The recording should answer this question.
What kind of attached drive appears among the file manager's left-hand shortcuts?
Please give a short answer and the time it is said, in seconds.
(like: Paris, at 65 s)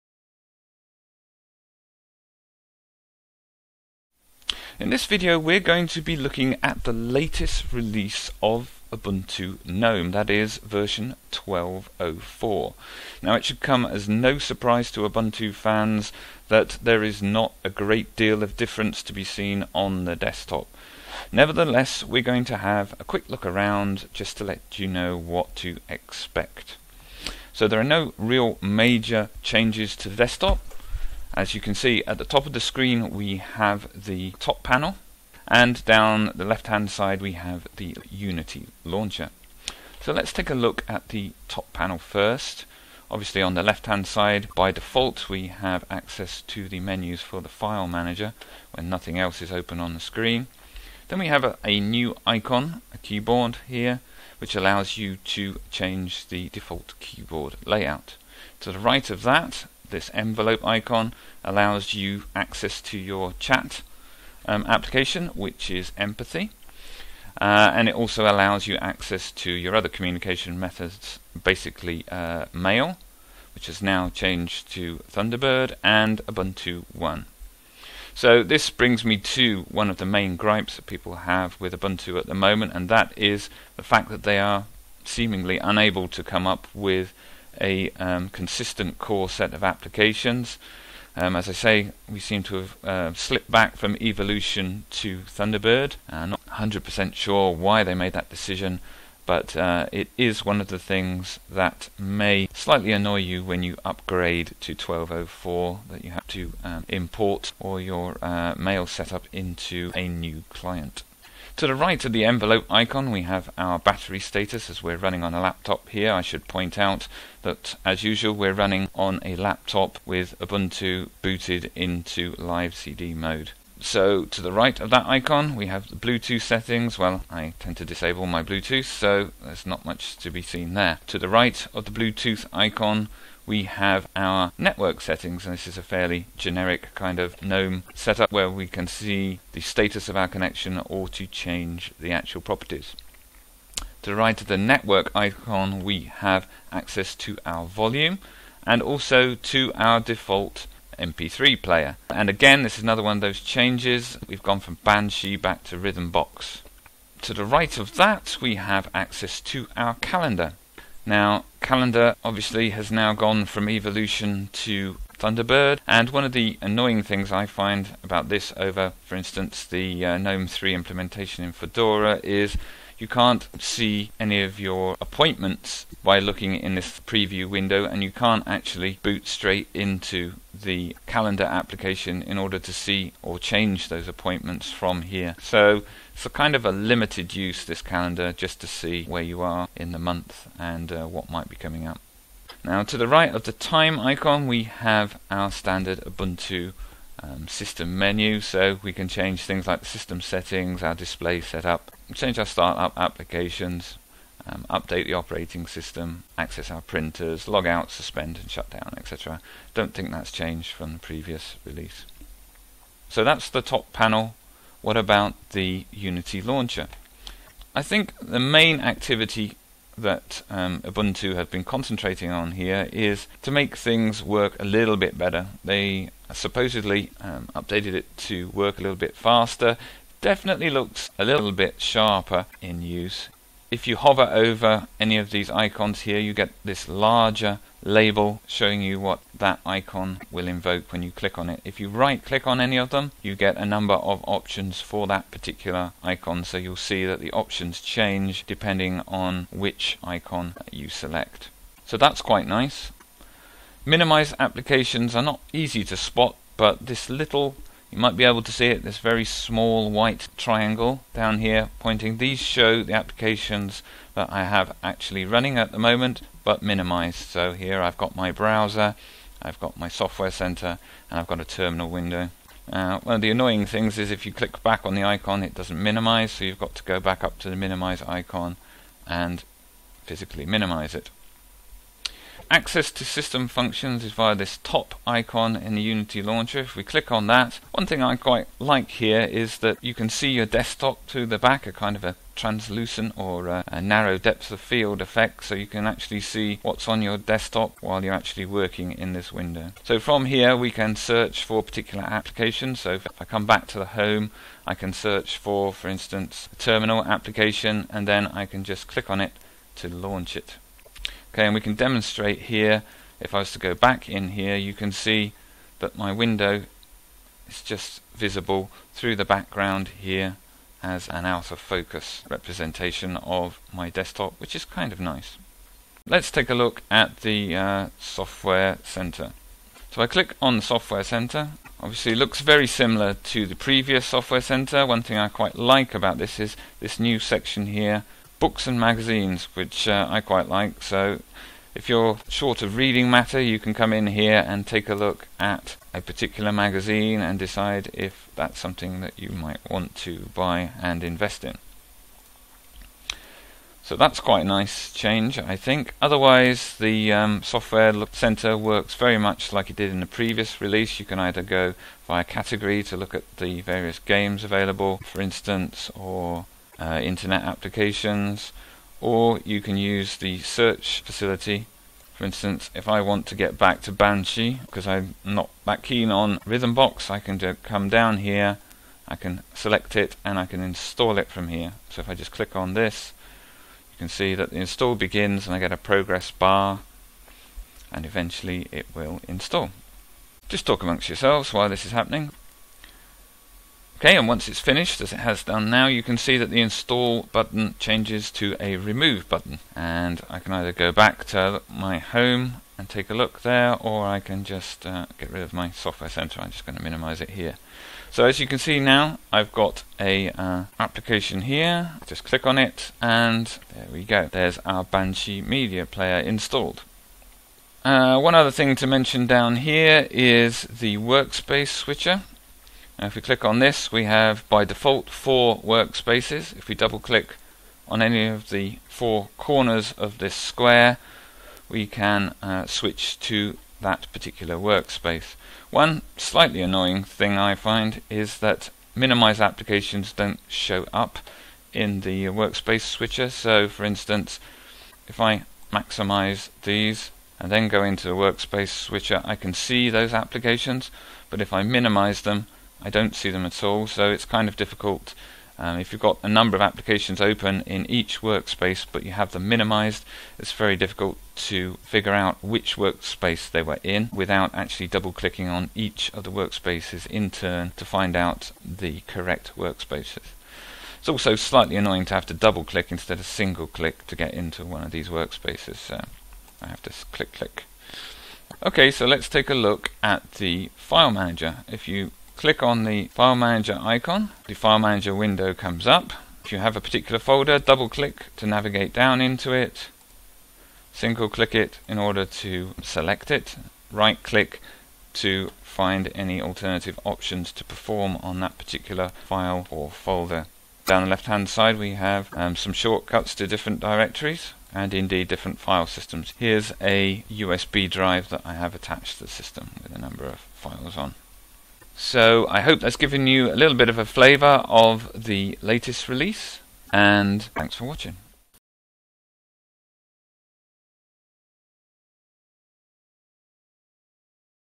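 USB drive, at 507 s.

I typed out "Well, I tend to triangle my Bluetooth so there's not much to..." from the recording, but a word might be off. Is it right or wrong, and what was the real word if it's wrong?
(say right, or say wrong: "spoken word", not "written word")
wrong: "disable", not "triangle".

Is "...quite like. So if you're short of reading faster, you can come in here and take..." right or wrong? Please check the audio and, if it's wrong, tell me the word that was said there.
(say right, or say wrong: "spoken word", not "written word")
wrong: "matter", not "faster".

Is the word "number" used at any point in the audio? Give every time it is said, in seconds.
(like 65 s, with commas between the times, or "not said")
243 s, 456 s, 509 s.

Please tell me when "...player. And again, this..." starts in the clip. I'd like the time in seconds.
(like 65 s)
151 s.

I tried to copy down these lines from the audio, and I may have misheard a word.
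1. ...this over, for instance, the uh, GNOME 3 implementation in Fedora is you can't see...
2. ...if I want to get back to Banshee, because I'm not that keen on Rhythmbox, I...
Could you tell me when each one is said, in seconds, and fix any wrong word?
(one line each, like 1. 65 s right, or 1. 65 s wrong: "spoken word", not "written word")
1. 168 s right
2. 372 s right.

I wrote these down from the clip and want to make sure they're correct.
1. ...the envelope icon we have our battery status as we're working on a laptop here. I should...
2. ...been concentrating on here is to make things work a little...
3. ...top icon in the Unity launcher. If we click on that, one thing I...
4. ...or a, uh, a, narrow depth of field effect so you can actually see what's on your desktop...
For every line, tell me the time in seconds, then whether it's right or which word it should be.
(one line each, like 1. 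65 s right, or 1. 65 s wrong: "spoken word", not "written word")
1. 112 s wrong: "running", not "working"
2. 221 s right
3. 284 s right
4. 293 s right.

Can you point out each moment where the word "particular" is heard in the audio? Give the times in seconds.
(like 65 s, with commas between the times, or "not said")
245 s, 301 s, 346 s, 434 s, 486 s, 498 s.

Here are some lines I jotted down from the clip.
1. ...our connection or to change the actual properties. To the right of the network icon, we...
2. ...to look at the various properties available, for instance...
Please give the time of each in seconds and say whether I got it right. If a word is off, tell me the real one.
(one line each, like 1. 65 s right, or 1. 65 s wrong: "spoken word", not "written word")
1. 140 s right
2. 362 s wrong: "games", not "properties".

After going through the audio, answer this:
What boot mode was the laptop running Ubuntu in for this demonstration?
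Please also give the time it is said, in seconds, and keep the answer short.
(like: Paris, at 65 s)
live CD mode, at 122 s.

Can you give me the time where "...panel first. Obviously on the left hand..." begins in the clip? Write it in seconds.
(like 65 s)
41 s.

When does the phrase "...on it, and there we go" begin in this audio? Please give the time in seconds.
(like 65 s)
412 s.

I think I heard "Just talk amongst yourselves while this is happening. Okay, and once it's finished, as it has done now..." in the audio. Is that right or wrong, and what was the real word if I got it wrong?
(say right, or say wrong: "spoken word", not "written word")
right.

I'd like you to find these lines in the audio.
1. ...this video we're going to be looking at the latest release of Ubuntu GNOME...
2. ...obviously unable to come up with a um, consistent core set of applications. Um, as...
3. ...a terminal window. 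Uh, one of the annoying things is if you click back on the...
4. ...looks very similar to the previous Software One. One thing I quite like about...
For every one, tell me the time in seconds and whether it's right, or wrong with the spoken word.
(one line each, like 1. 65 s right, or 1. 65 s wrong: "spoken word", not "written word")
1. 4 s right
2. 85 s wrong: "seemingly", not "obviously"
3. 271 s right
4. 332 s wrong: "Center", not "One".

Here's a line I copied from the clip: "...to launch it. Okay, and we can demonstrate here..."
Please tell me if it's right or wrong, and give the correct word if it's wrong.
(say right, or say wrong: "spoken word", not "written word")
right.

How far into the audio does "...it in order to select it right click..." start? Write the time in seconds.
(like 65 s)
491 s.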